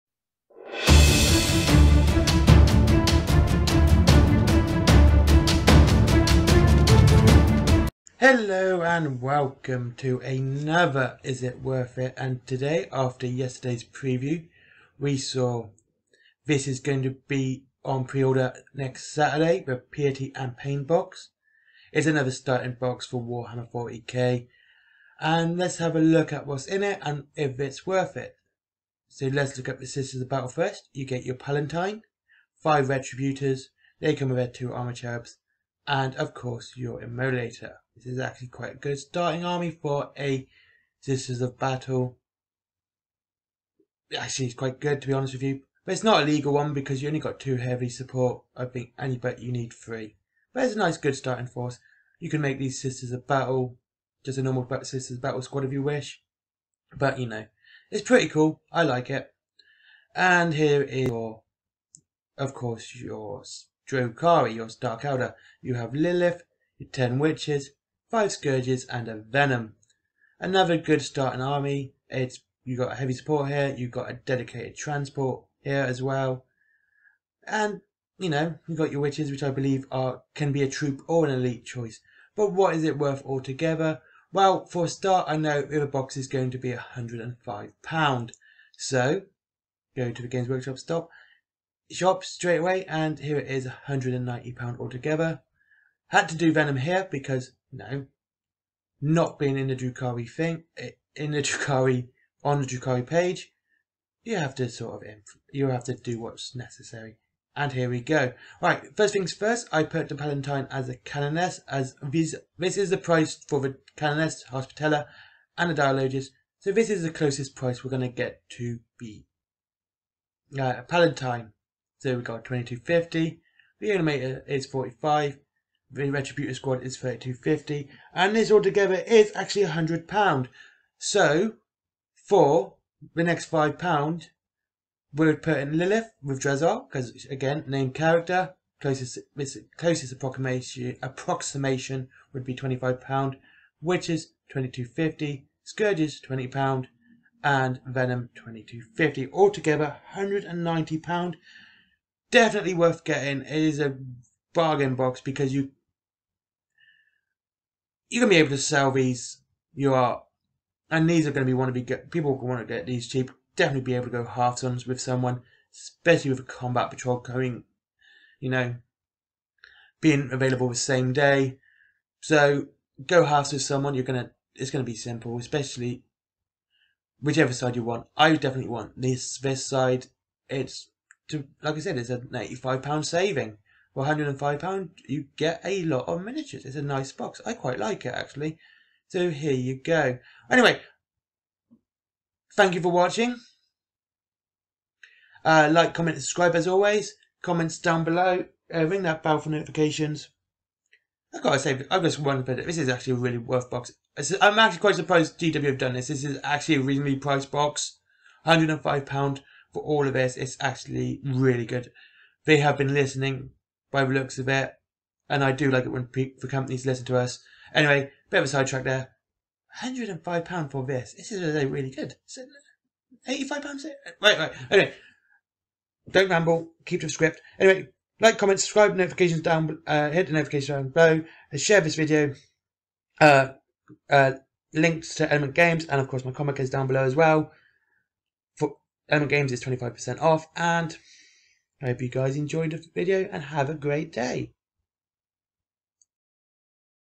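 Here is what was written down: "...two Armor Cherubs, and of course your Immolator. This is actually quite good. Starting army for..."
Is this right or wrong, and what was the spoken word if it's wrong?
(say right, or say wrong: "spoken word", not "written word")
right.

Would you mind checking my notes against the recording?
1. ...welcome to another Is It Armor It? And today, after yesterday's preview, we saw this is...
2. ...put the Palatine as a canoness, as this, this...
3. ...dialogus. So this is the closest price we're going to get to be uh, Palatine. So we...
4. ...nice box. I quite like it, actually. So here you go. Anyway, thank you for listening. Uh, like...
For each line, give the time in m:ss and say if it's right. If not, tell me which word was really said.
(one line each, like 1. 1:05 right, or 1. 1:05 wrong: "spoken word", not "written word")
1. 0:09 wrong: "Worth", not "Armor"
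2. 1:49 right
3. 1:55 right
4. 3:06 wrong: "watching", not "listening".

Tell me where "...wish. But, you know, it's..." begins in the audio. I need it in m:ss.
0:55.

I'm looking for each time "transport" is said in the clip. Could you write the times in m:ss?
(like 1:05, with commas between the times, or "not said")
1:14.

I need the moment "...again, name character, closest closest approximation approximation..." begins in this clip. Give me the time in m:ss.
2:17.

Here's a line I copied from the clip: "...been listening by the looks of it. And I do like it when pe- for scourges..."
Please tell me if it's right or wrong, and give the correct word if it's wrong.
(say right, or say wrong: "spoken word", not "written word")
wrong: "companies", not "scourges".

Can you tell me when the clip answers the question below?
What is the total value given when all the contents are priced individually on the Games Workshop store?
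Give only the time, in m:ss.
1:33.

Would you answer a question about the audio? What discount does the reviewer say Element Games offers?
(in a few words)
25%.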